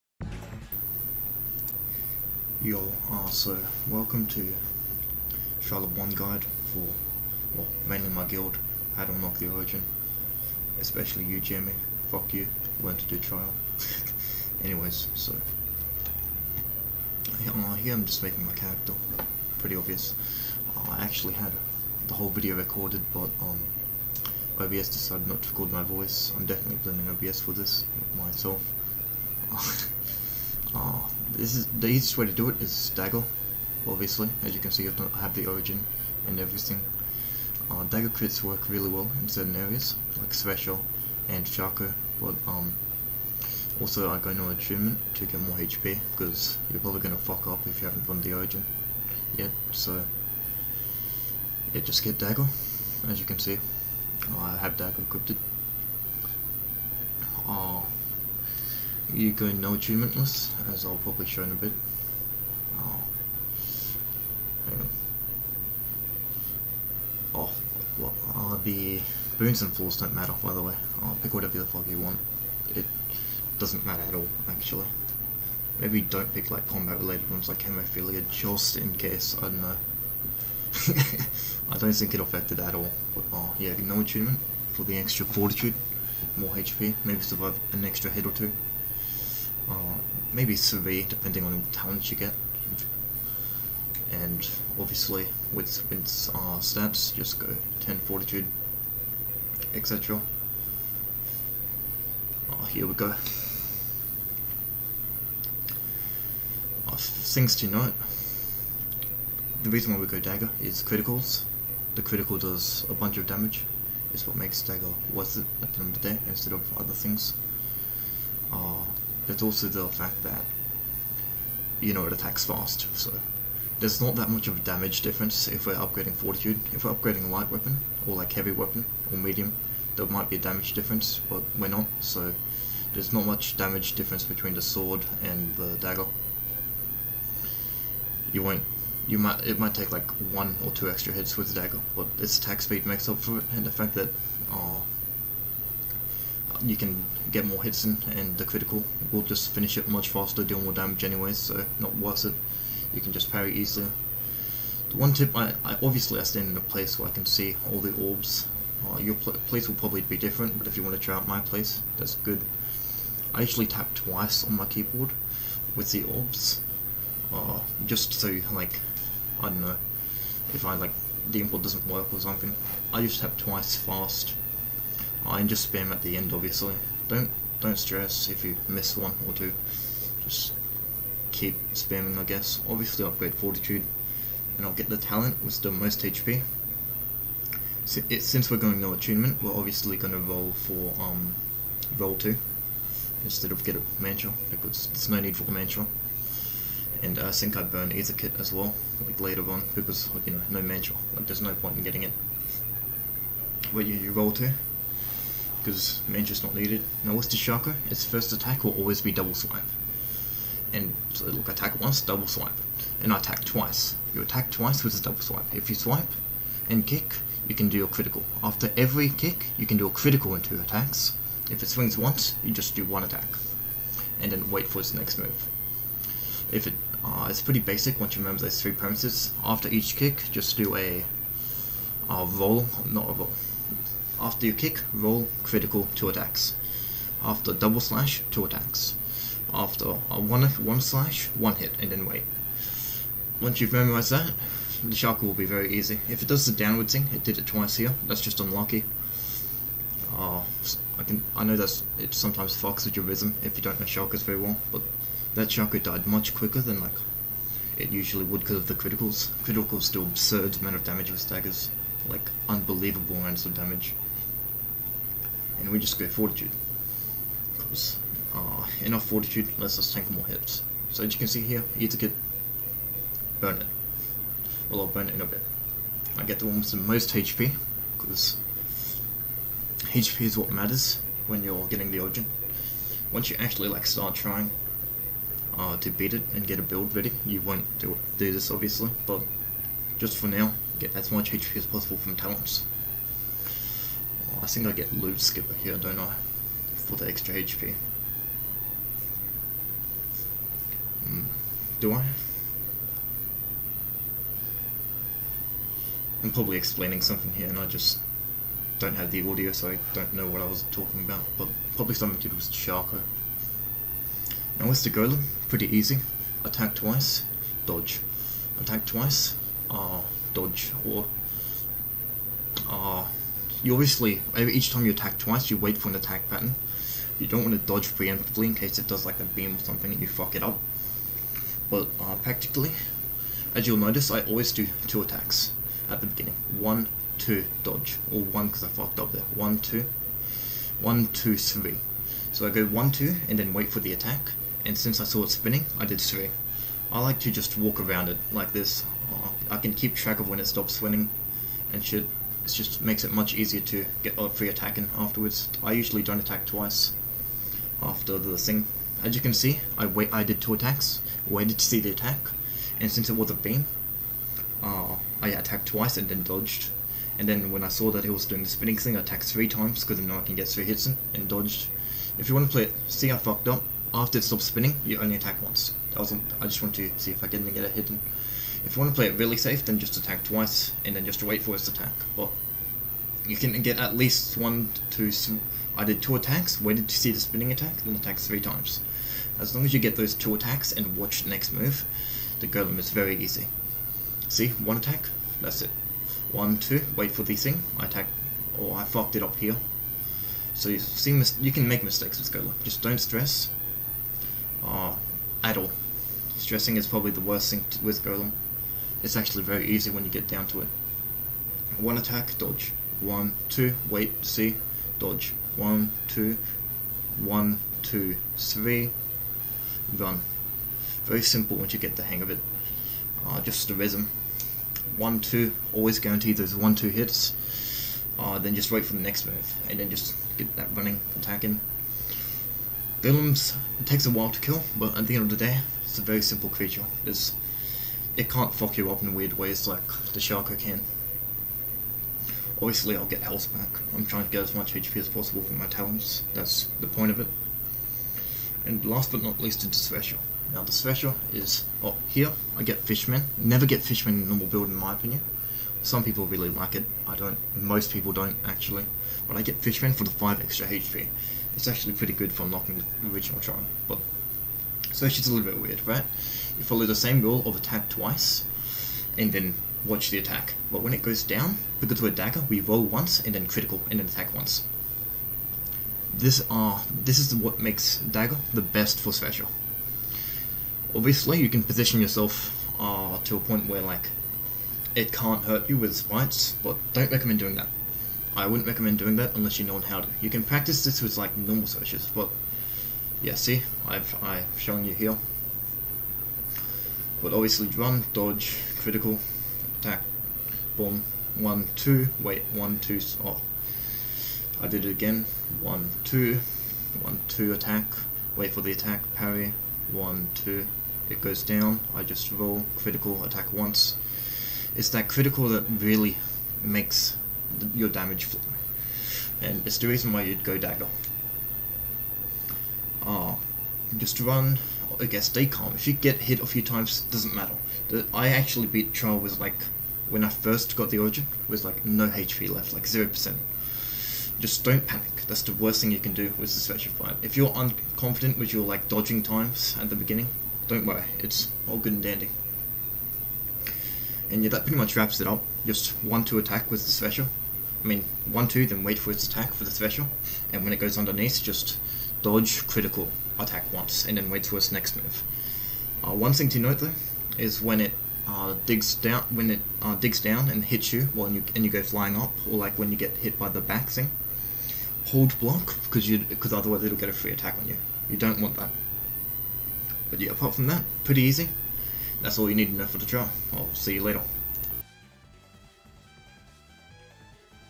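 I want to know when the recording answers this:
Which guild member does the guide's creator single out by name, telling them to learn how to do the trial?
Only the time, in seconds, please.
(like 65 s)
11 s.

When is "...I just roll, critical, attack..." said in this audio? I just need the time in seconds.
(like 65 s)
511 s.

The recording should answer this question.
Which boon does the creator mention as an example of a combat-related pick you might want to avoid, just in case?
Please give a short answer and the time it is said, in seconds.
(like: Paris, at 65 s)
Hemophilia, at 77 s.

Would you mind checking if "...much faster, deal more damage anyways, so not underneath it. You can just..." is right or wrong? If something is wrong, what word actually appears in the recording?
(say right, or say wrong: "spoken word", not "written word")
wrong: "worth", not "underneath".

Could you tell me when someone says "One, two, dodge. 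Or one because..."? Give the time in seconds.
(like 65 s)
336 s.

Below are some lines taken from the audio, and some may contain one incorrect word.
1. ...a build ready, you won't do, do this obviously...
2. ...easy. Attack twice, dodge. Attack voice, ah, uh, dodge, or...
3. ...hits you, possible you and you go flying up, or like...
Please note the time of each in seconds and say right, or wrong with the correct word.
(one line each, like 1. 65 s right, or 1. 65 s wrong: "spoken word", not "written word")
1. 286 s right
2. 315 s wrong: "twice", not "voice"
3. 560 s wrong: "while", not "possible".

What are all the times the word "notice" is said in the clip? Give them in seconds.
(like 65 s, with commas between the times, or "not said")
333 s.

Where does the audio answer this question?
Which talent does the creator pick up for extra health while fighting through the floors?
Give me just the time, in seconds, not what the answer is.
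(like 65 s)
294 s.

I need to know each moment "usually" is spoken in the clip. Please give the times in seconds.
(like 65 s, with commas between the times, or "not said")
163 s, 257 s, 355 s.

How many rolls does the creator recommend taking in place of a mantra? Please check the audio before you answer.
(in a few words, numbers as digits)
2.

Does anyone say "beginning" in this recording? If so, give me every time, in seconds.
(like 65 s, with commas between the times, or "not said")
336 s, 539 s.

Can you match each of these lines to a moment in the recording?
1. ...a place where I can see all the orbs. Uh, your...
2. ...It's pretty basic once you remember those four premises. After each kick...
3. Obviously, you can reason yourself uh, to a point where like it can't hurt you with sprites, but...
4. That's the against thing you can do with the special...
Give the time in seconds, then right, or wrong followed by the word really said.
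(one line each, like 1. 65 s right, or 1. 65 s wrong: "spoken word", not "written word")
1. 156 s right
2. 227 s wrong: "three", not "four"
3. 480 s wrong: "position", not "reason"
4. 535 s wrong: "worst", not "against".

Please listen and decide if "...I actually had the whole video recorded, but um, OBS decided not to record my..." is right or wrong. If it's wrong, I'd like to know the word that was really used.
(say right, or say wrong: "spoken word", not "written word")
right.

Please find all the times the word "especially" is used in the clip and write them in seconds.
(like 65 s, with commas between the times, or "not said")
10 s.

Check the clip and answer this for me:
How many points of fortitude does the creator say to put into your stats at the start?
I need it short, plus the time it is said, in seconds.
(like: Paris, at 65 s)
10, at 97 s.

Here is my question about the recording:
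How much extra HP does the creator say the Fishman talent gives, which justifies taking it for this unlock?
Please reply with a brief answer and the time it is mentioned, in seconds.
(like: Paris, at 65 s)
5, at 460 s.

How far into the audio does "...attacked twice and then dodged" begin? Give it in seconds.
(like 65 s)
365 s.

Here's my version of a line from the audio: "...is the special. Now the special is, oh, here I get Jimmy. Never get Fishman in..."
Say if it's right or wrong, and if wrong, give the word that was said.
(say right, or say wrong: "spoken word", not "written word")
wrong: "Fishman", not "Jimmy".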